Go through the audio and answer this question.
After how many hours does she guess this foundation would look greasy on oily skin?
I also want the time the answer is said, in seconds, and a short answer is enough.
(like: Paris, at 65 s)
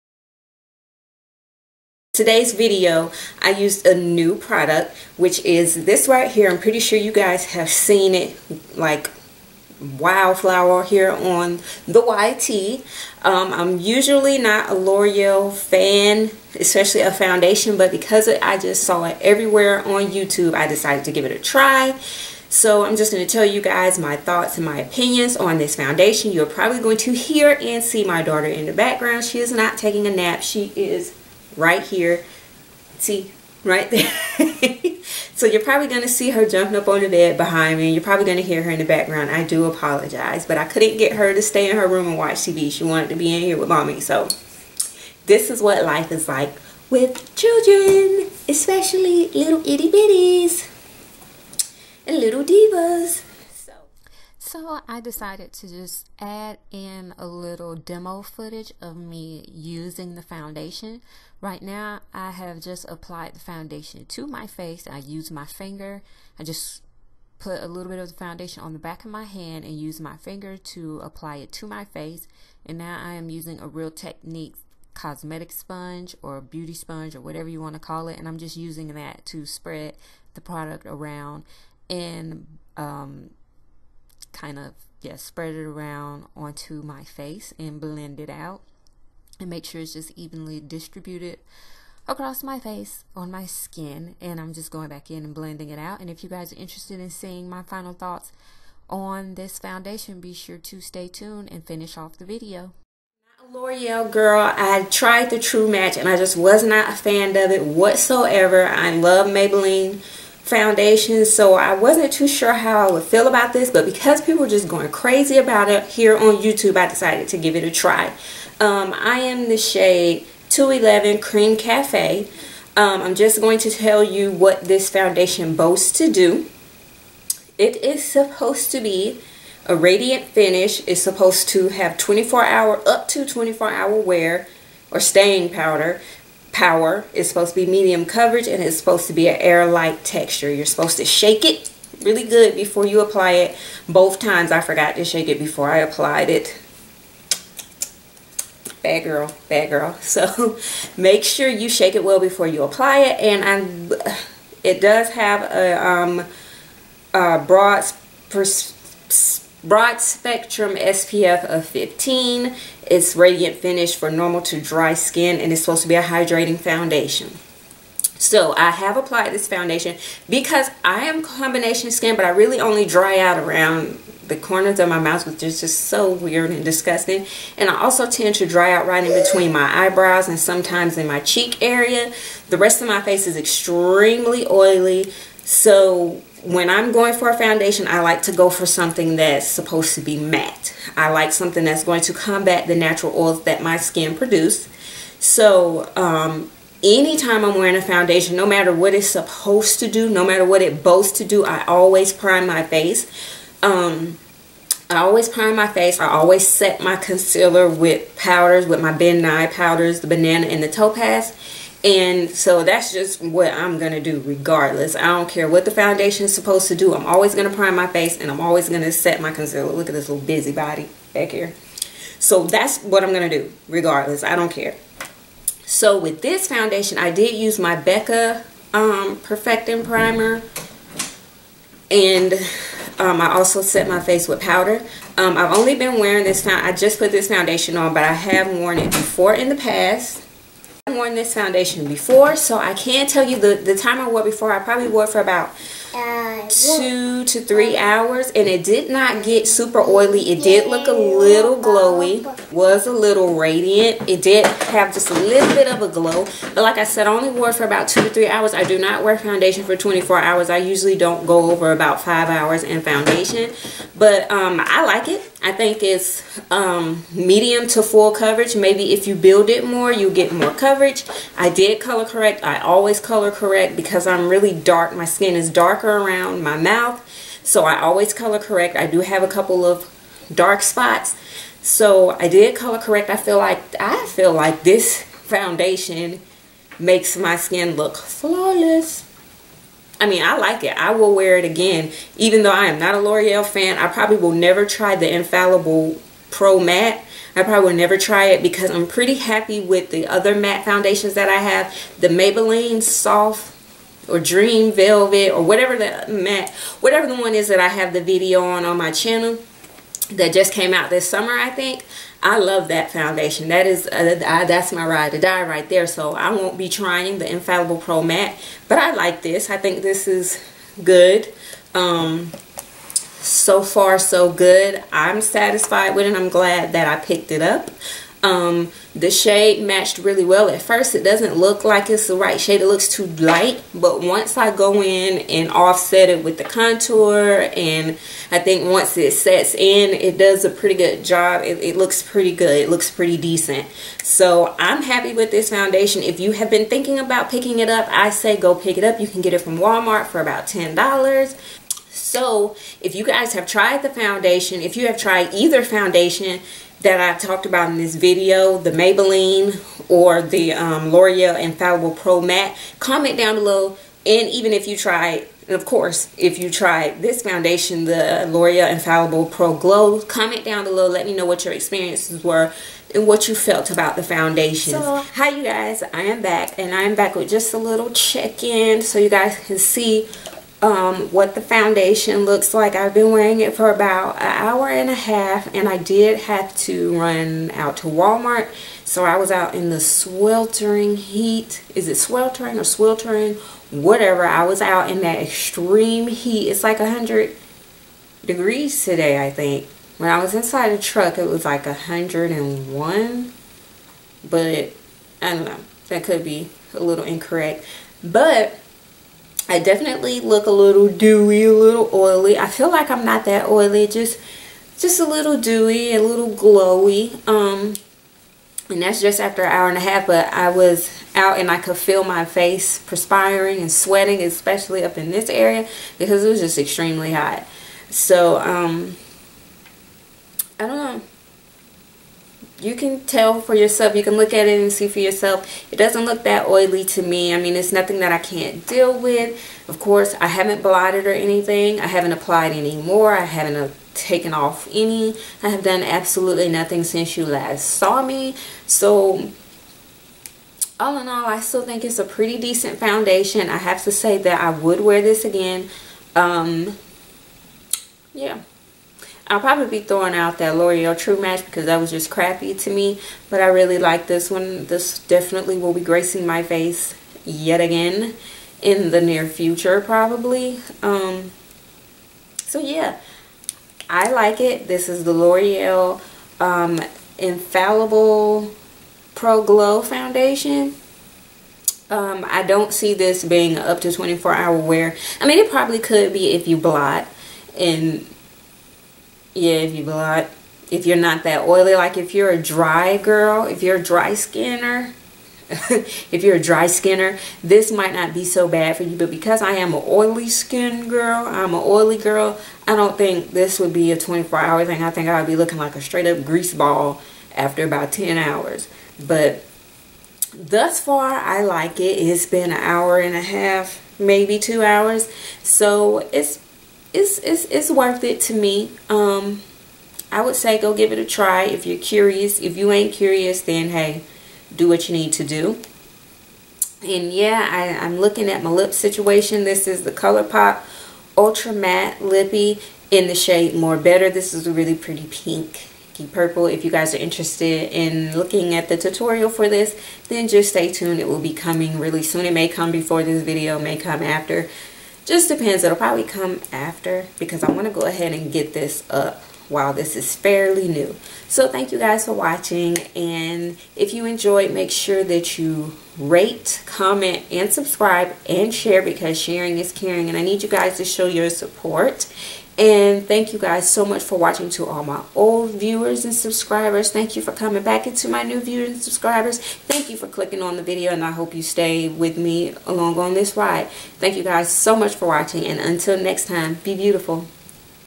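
10, at 507 s.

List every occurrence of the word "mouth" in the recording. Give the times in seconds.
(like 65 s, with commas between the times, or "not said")
174 s, 276 s.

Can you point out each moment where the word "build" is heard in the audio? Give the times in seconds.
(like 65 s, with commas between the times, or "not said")
269 s.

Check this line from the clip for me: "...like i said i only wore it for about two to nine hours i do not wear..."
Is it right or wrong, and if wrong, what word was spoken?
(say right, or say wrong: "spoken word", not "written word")
wrong: "three", not "nine".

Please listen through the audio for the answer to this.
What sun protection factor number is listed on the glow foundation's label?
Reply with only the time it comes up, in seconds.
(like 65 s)
160 s.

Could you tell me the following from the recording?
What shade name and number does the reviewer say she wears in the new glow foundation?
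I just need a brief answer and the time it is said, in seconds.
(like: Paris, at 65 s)
211 Cream Cafe, at 120 s.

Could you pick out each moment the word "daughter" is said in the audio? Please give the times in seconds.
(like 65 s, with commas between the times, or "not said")
28 s.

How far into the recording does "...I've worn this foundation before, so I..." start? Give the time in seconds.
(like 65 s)
240 s.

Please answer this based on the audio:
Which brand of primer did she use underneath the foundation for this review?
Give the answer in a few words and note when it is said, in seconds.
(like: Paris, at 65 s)
Becca, at 227 s.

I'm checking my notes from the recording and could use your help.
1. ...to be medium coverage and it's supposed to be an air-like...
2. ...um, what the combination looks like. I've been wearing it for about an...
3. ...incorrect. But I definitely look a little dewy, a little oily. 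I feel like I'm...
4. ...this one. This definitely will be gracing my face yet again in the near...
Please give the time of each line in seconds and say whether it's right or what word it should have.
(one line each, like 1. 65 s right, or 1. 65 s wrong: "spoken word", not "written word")
1. 137 s right
2. 380 s wrong: "foundation", not "combination"
3. 407 s right
4. 464 s right.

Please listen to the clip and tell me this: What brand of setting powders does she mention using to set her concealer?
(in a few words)
Ben Nye.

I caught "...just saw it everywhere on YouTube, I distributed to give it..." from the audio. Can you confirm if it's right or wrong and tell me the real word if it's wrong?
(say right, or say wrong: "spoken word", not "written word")
wrong: "decided", not "distributed".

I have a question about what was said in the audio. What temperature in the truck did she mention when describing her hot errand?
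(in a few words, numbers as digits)
101.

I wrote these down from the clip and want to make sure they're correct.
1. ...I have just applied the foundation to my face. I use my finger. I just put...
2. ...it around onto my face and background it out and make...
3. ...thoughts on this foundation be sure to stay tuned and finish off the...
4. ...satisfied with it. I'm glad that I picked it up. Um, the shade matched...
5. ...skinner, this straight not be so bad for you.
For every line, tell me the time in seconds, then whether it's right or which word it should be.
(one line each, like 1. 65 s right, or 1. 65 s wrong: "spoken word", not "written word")
1. 62 s right
2. 85 s wrong: "blend", not "background"
3. 97 s right
4. 325 s right
5. 496 s wrong: "might", not "straight".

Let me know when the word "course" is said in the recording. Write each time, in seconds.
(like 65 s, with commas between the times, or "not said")
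365 s, 439 s.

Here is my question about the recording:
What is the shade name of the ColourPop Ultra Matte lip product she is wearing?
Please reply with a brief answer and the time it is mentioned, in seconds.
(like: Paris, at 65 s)
More Better, at 533 s.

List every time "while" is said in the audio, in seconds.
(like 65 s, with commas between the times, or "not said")
549 s.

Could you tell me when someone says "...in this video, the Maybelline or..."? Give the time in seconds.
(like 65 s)
357 s.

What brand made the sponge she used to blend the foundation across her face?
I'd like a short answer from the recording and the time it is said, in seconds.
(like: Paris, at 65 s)
Real Techniques, at 73 s.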